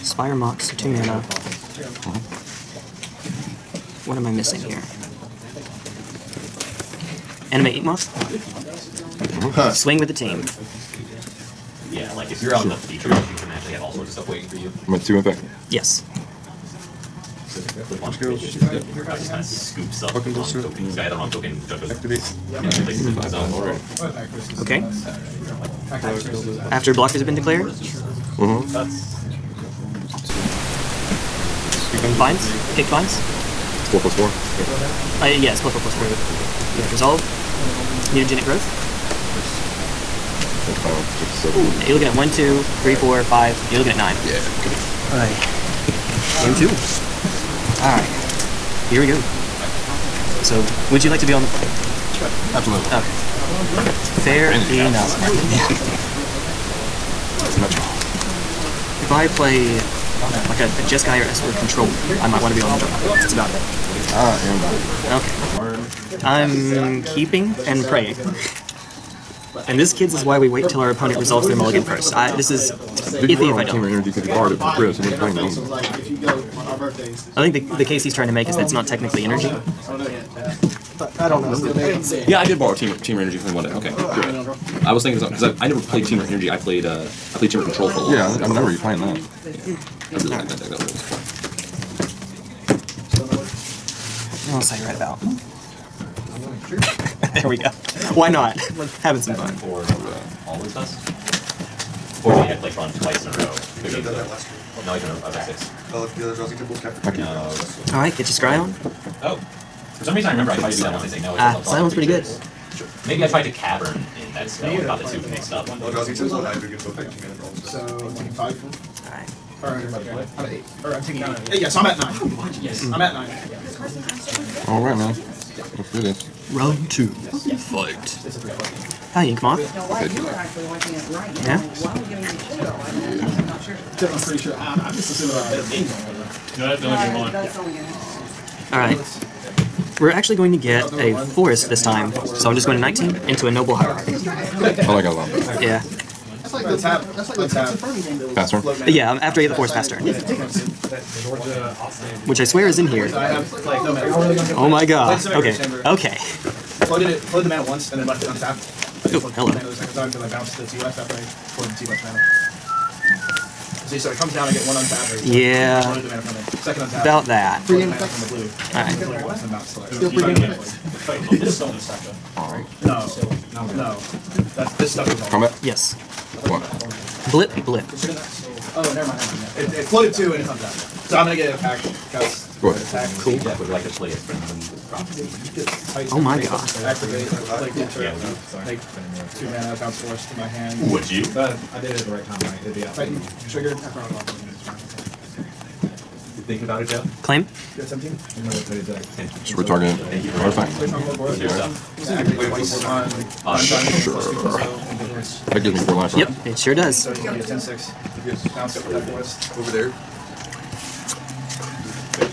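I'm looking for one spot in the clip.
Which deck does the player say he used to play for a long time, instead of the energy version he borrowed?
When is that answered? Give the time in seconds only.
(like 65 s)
87 s.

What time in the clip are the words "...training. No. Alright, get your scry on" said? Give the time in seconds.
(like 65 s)
107 s.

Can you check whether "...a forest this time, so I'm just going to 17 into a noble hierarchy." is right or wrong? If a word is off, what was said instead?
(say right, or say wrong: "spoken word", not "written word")
wrong: "19", not "17".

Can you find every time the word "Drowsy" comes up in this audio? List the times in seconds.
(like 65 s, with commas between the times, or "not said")
106 s, 115 s.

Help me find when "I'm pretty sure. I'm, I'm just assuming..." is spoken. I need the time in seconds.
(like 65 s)
134 s.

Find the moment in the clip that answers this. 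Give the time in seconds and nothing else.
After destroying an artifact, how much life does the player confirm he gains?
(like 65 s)
205 s.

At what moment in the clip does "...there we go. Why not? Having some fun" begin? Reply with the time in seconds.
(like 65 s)
97 s.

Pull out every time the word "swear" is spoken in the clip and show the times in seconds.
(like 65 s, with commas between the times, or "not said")
152 s.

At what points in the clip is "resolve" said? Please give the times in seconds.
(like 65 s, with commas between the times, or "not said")
36 s, 71 s.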